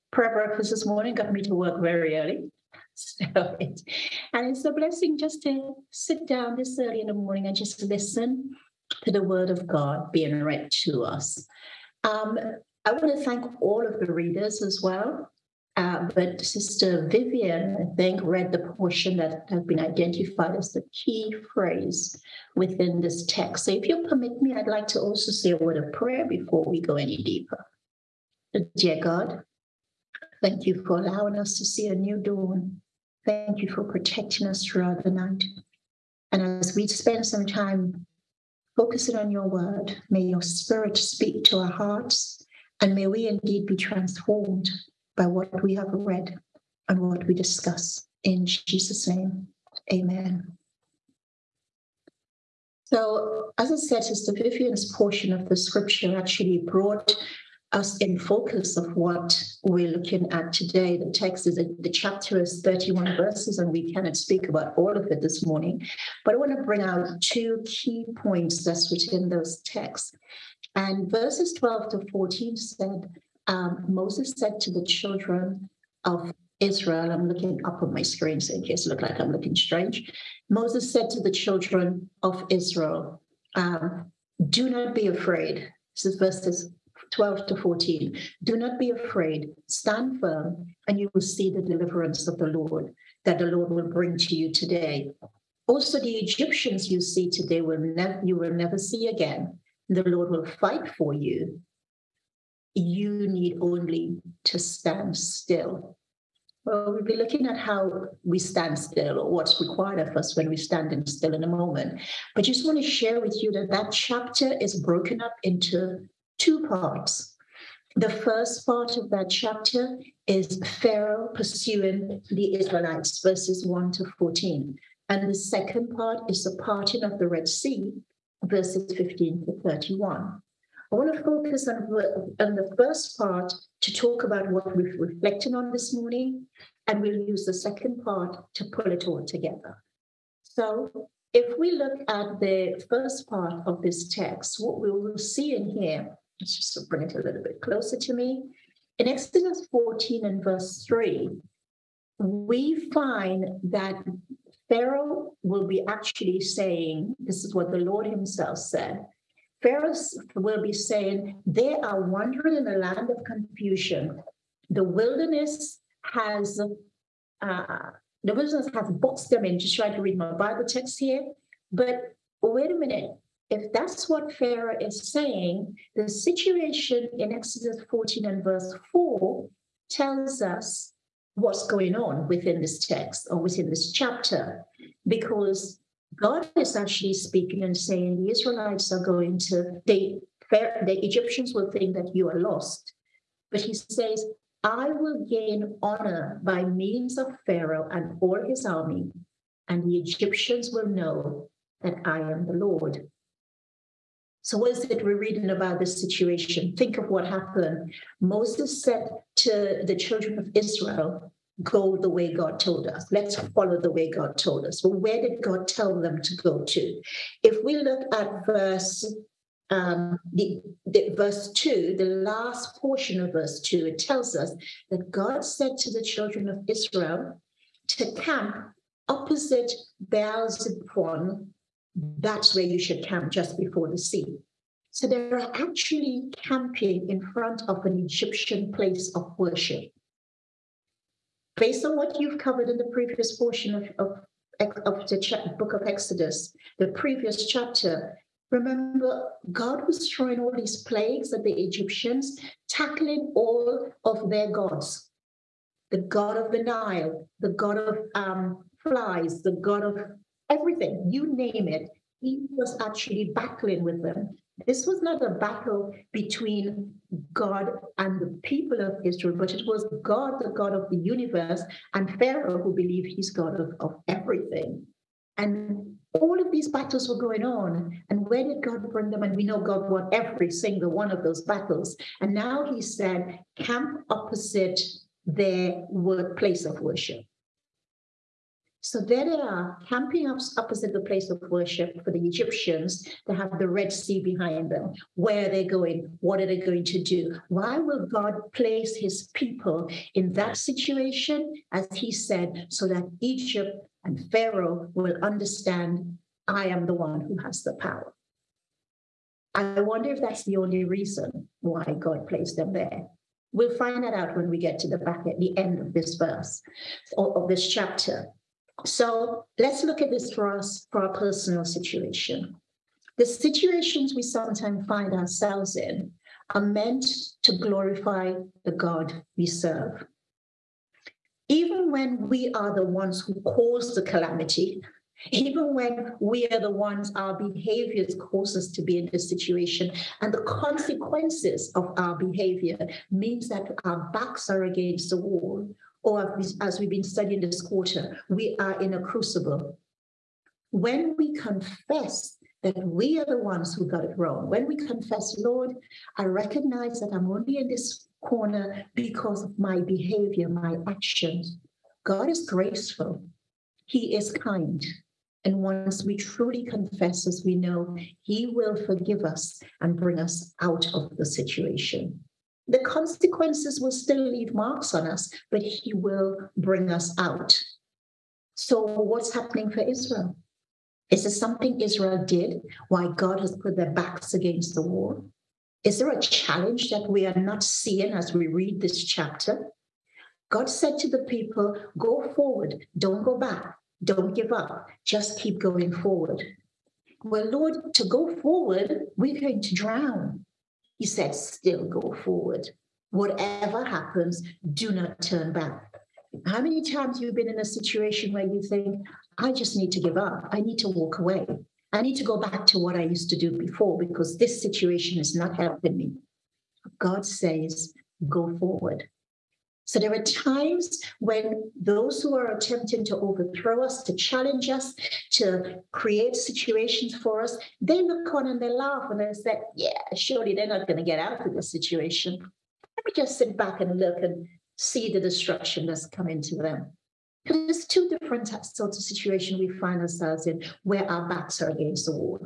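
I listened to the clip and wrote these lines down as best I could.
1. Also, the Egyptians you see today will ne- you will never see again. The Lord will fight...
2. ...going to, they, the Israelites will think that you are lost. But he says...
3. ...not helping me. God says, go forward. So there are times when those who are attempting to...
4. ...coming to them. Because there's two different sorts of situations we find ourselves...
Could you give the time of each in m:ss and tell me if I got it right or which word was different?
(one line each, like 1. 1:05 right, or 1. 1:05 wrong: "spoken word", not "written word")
1. 1:35 right
2. 3:09 wrong: "Egyptians", not "Israelites"
3. 6:55 right
4. 7:16 right.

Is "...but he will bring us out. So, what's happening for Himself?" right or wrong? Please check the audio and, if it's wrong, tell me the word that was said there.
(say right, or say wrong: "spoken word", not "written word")
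wrong: "Israel", not "Himself".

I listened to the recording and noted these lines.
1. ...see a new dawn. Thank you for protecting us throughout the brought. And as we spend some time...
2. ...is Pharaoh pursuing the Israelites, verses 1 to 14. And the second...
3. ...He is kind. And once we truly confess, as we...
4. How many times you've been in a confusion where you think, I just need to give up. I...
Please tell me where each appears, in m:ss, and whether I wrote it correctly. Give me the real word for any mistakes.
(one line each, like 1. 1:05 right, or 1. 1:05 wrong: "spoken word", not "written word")
1. 0:31 wrong: "night", not "brought"
2. 2:00 right
3. 6:03 right
4. 6:46 wrong: "situation", not "confusion".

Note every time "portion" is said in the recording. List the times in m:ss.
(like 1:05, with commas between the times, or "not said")
0:18, 0:54, 3:42, 4:03.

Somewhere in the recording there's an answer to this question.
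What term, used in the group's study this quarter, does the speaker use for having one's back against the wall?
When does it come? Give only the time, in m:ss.
5:49.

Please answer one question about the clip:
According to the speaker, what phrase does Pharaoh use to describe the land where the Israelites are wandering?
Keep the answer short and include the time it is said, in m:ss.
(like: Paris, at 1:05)
land of confusion, at 2:42.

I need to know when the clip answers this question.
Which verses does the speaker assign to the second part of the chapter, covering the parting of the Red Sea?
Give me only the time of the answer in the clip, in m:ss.
2:08.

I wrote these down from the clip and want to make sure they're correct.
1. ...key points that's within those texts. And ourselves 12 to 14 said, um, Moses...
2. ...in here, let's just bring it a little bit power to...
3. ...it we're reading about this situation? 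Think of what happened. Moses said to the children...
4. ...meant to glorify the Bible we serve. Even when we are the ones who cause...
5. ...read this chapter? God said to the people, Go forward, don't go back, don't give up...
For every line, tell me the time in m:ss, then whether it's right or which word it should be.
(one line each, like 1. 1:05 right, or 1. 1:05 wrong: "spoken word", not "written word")
1. 1:07 wrong: "verses", not "ourselves"
2. 2:25 wrong: "closer", not "power"
3. 3:24 right
4. 5:26 wrong: "God", not "Bible"
5. 6:28 right.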